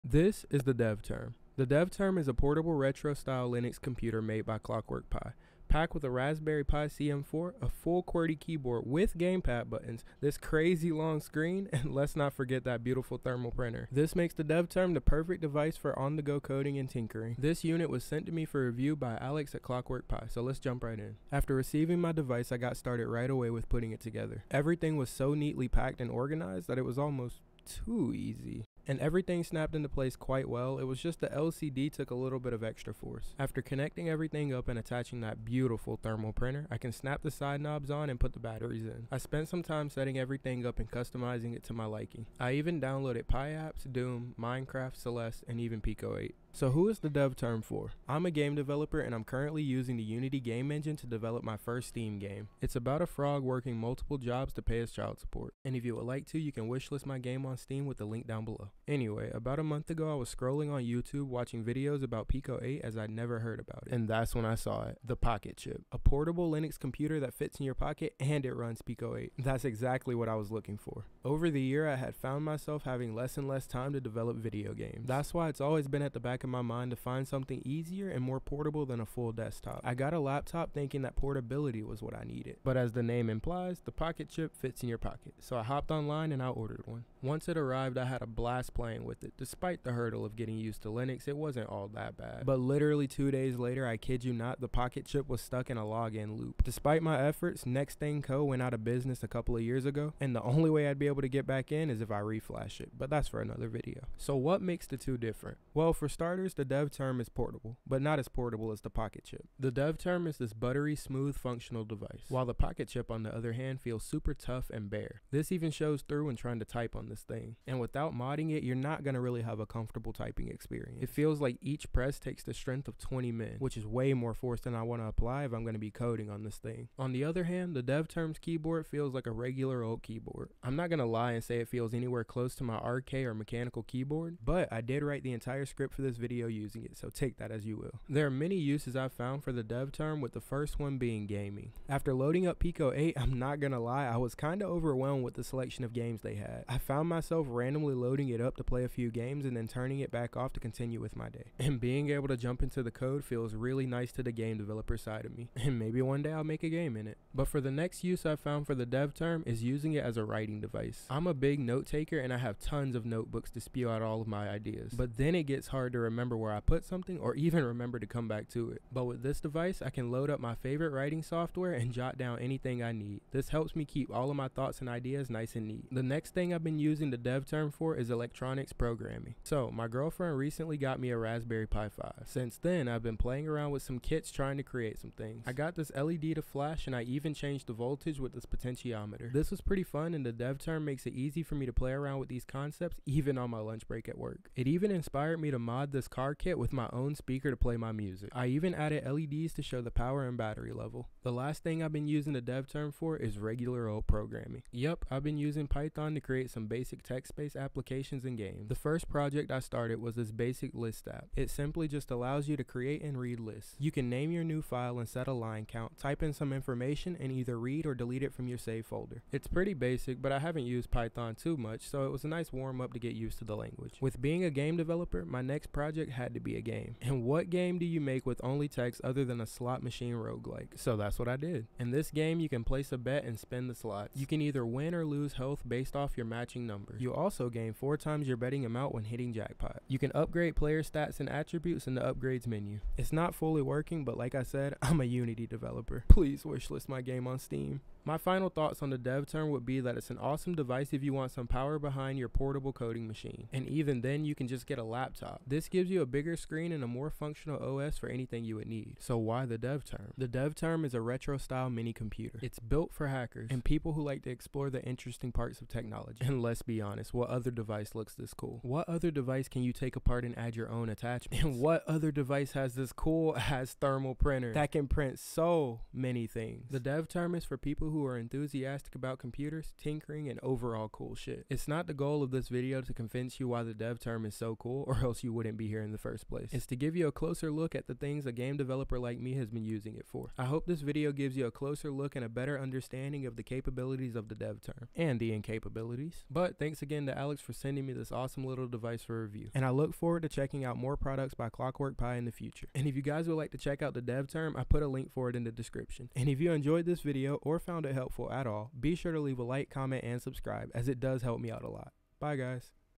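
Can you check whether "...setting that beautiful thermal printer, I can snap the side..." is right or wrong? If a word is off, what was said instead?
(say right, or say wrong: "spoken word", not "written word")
wrong: "attaching", not "setting".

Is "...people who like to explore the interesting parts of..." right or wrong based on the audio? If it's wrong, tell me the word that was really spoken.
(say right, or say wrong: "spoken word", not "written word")
right.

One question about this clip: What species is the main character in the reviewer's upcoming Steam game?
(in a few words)
frog.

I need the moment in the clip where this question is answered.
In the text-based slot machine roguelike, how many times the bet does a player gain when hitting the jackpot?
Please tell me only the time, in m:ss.
3:57.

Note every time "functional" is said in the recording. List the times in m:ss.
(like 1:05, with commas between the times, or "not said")
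1:51, 4:17.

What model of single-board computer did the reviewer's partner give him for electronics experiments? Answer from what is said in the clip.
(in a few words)
Raspberry Pi 5.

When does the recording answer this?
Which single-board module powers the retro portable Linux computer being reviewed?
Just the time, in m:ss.
0:06.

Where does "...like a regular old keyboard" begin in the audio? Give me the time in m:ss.
2:09.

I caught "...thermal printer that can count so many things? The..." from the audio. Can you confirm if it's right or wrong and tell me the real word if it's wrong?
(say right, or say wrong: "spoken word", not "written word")
wrong: "print", not "count".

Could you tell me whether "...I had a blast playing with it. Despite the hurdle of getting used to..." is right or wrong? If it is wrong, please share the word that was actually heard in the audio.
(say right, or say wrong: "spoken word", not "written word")
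right.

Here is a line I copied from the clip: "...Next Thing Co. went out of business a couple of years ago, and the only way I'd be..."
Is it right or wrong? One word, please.
right.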